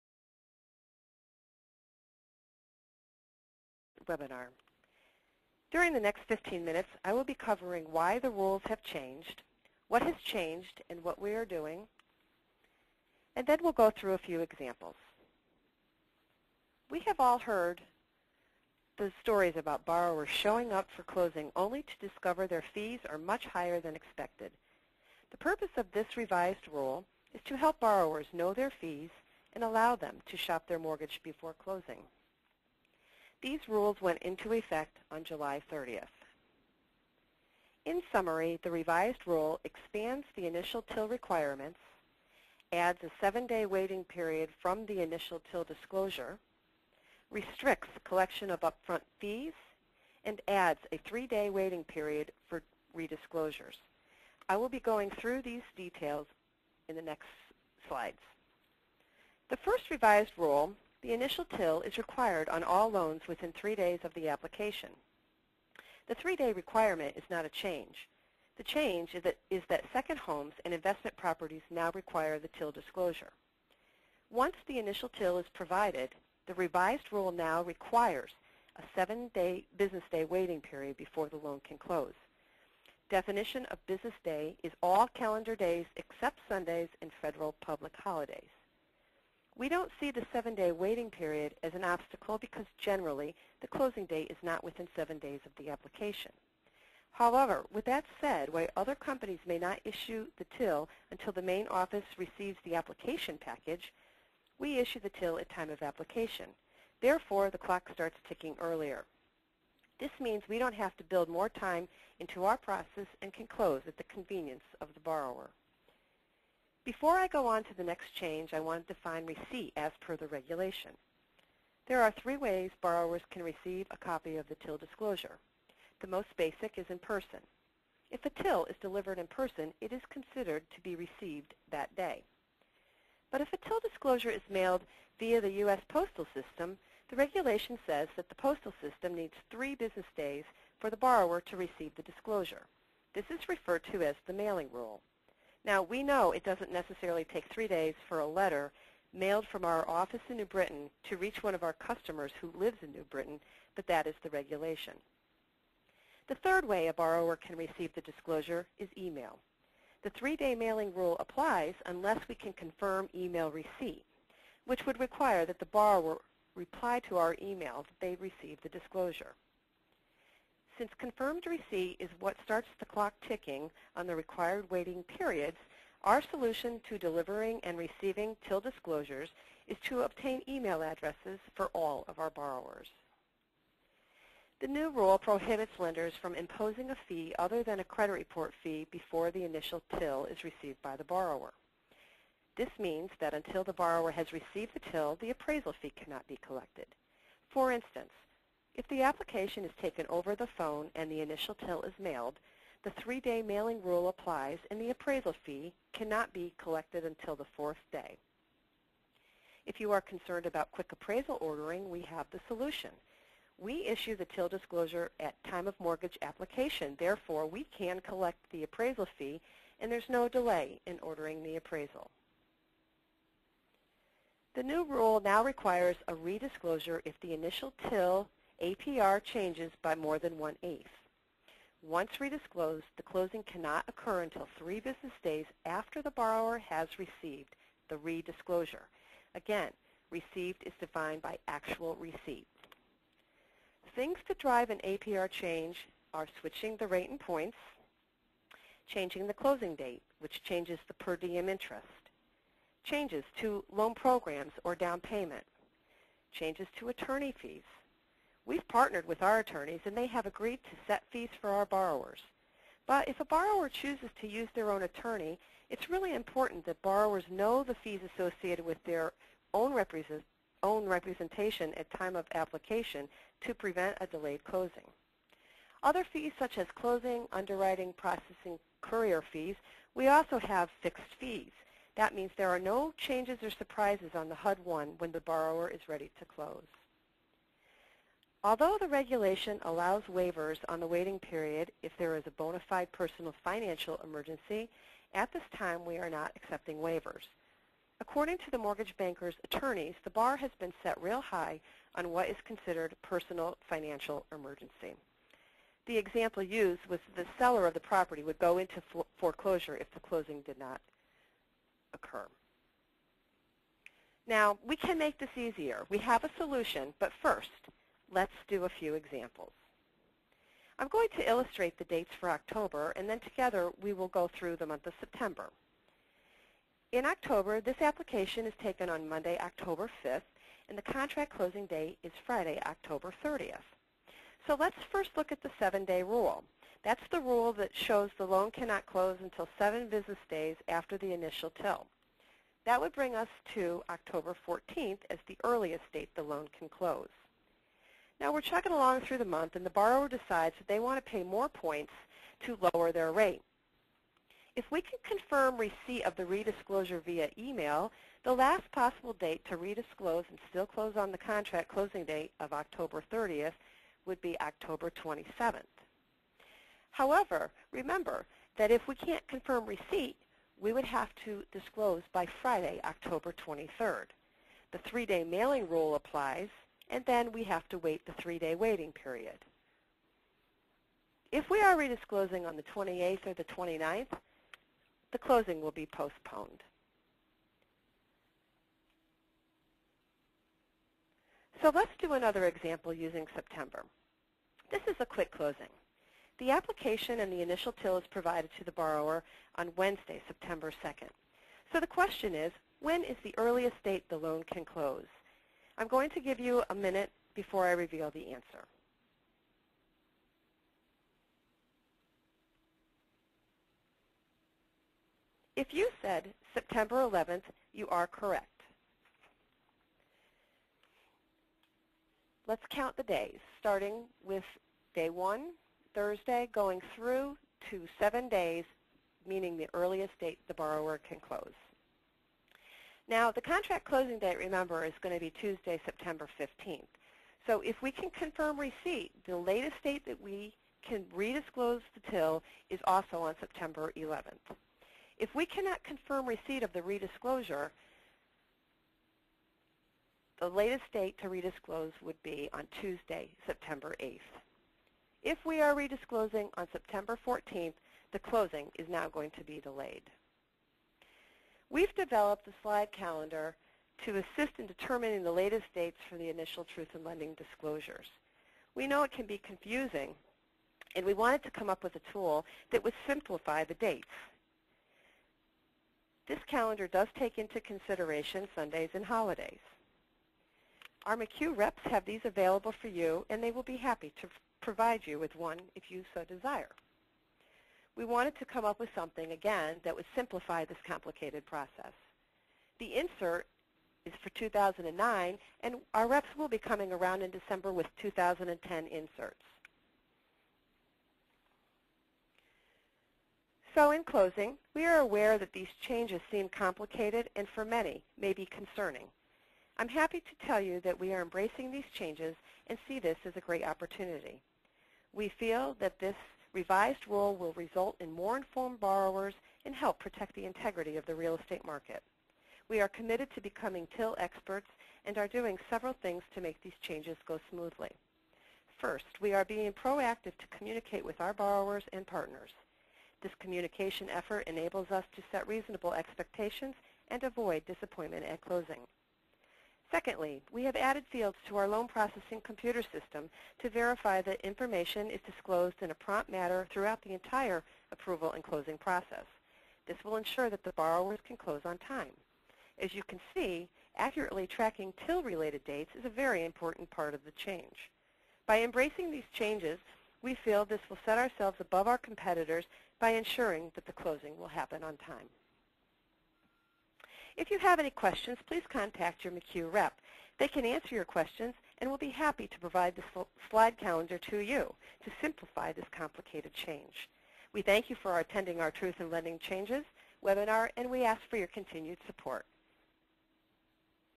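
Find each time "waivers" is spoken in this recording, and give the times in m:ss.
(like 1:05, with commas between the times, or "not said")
4:50, 4:56.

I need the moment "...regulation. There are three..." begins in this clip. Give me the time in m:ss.
2:00.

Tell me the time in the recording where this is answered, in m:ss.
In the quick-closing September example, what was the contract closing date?
7:15.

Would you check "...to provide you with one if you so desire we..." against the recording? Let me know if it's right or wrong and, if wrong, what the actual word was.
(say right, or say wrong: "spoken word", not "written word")
right.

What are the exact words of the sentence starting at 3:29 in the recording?
If you are concerned about quick appraisal ordering, we have the solution.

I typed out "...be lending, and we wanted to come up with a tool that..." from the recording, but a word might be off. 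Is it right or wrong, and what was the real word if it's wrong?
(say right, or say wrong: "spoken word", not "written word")
wrong: "confusing", not "lending".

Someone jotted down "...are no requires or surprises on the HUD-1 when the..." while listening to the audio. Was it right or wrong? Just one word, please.
wrong.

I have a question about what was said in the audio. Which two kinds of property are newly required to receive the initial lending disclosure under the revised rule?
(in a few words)
Second homes and investment properties.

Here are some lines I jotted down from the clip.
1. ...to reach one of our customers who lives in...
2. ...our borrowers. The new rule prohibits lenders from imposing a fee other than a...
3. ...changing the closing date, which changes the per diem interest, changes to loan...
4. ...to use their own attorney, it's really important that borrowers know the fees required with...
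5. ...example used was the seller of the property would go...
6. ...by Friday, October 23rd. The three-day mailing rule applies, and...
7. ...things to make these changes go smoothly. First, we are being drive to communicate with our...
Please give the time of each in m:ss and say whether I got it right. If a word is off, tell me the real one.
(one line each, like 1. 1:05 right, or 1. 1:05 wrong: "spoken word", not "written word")
1. 2:31 right
2. 3:02 right
3. 4:08 right
4. 4:24 wrong: "associated", not "required"
5. 5:05 right
6. 6:12 right
7. 8:45 wrong: "proactive", not "drive".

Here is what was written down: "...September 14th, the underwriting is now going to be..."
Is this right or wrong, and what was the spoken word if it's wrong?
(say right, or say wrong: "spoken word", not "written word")
wrong: "closing", not "underwriting".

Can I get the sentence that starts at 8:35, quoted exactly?
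We feel that this revised rule will result in more informed borrowers and help protect the integrity of the real estate market.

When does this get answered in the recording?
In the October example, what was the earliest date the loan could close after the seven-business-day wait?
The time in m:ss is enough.
5:43.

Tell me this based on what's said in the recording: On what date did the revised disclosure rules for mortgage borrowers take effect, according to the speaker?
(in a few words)
July 30th.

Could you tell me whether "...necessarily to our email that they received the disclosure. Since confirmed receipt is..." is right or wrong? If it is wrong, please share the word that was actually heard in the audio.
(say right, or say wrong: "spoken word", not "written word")
wrong: "reply", not "necessarily".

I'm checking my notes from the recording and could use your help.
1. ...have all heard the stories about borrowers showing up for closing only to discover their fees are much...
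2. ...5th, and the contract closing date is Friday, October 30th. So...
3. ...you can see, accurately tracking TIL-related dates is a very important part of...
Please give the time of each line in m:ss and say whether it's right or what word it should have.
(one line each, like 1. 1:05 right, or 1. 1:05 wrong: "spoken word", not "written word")
1. 0:17 right
2. 5:30 right
3. 9:12 right.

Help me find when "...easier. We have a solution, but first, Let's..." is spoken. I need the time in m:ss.
5:15.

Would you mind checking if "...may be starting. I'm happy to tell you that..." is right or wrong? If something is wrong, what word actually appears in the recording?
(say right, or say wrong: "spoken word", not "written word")
wrong: "concerning", not "starting".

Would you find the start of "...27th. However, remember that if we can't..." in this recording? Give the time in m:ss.
6:05.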